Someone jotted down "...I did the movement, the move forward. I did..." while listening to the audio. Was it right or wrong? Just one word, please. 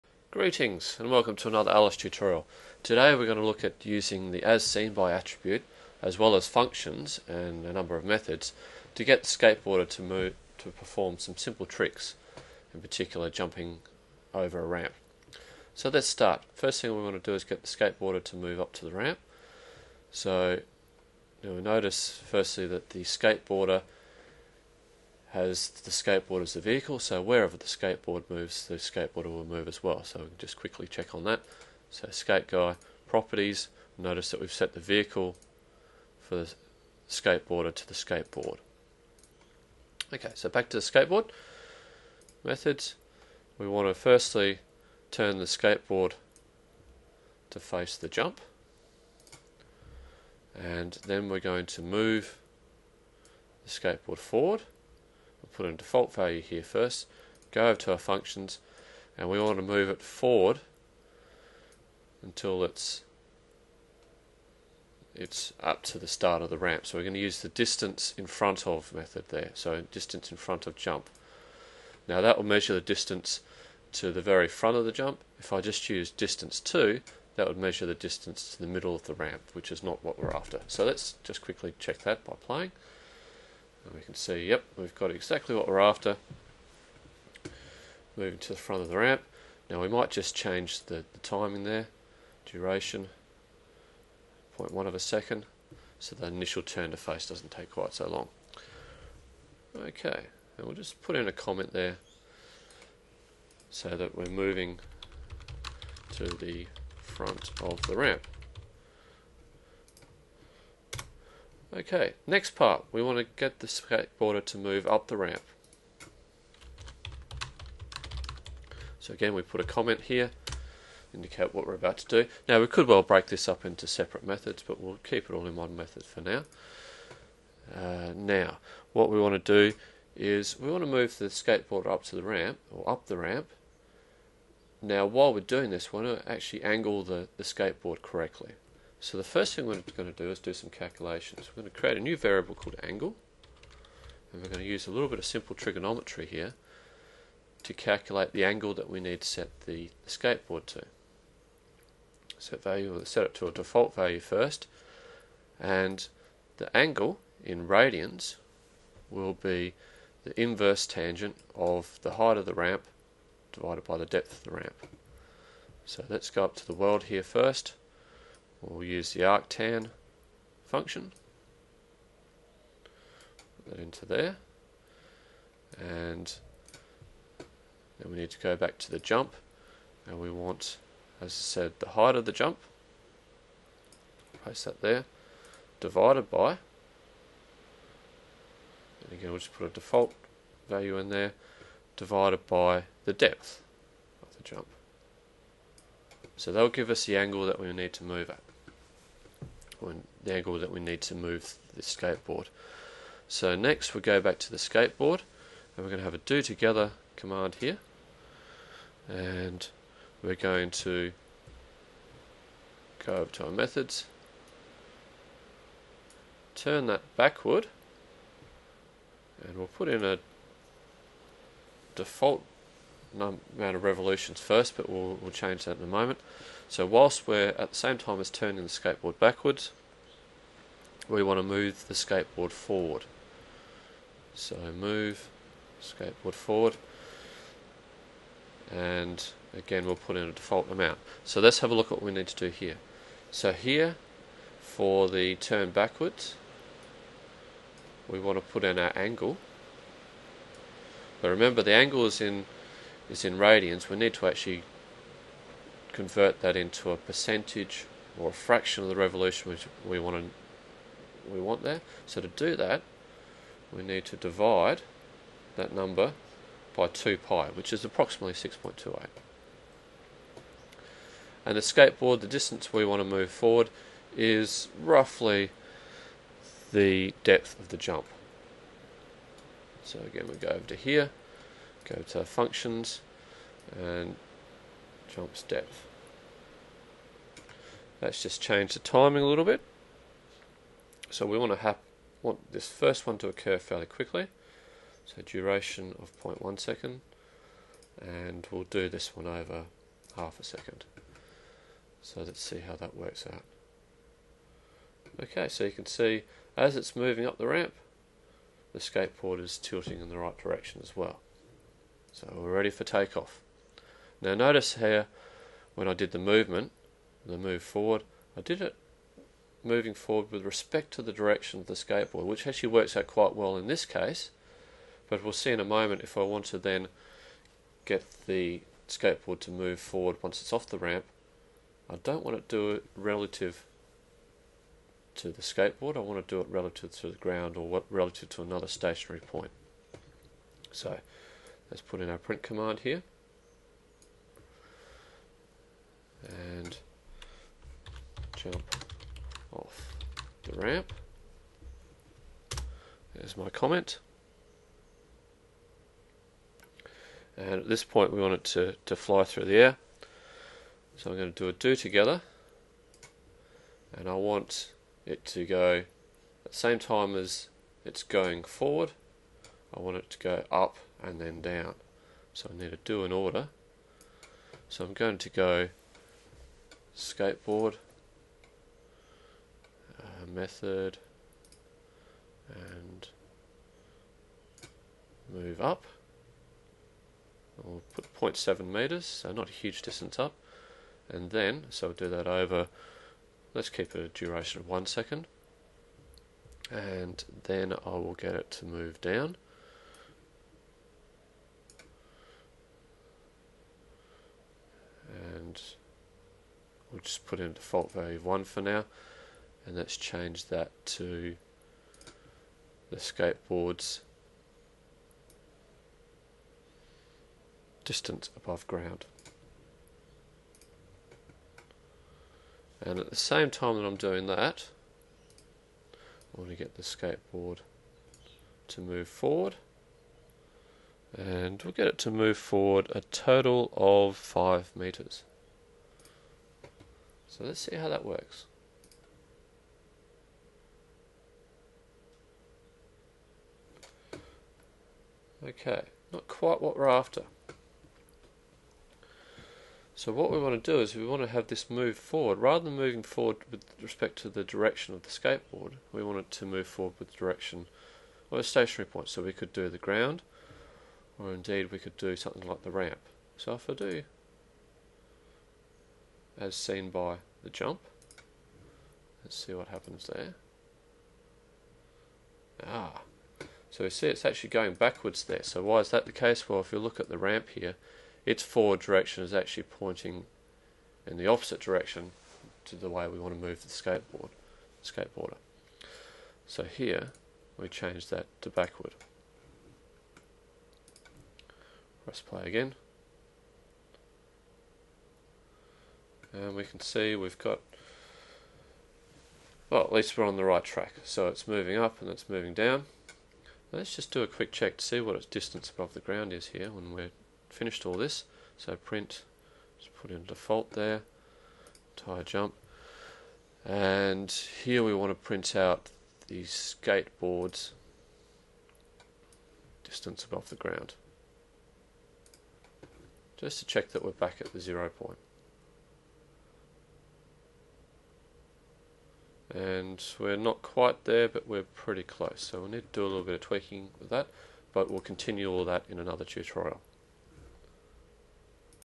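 right.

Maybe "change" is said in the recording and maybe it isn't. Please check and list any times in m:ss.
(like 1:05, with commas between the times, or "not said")
1:30, 3:45, 4:48, 6:49, 8:07.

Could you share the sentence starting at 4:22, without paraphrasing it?
So to do that, we need to divide that number by 2 pi, which is approximately 6.28.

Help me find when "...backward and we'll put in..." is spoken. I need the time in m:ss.
3:37.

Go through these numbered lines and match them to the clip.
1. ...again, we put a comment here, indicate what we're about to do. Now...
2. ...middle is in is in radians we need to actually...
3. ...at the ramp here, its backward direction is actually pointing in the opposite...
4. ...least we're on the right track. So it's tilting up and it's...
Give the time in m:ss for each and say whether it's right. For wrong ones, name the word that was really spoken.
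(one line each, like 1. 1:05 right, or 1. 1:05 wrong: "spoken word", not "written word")
1. 1:59 right
2. 4:11 wrong: "angle", not "middle"
3. 7:56 wrong: "forward", not "backward"
4. 8:19 wrong: "moving", not "tilting".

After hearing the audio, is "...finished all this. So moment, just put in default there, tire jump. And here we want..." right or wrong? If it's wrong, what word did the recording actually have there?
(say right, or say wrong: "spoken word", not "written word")
wrong: "print", not "moment".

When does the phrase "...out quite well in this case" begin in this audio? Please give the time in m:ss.
5:22.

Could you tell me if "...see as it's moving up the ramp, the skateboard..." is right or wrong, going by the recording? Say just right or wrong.
right.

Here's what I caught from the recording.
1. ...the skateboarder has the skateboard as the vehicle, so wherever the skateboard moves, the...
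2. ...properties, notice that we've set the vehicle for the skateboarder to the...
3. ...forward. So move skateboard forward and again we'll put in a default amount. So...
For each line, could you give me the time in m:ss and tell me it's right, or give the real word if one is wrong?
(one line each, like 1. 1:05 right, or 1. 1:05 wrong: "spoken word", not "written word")
1. 0:22 right
2. 0:33 right
3. 3:52 right.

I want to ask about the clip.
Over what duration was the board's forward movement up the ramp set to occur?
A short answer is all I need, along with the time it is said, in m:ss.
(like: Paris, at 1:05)
half a second, at 5:00.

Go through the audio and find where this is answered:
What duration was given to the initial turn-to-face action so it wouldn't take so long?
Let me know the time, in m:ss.
1:34.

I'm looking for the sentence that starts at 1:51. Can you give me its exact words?
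Okay, next part, we want to get the skateboarder to move up the ramp.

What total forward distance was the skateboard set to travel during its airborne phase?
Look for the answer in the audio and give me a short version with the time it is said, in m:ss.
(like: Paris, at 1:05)
5 meters, at 7:14.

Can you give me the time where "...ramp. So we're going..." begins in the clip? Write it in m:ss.
1:06.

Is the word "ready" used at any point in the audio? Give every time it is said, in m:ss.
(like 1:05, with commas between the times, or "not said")
5:12.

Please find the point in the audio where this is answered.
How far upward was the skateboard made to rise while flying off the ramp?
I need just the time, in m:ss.
6:28.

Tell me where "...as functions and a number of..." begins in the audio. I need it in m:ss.
0:06.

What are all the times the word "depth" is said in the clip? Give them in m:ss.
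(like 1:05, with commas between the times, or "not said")
2:44, 3:13, 4:37, 4:45.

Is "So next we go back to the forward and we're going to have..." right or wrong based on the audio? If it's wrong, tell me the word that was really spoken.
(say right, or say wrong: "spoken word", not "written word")
wrong: "skateboard", not "forward".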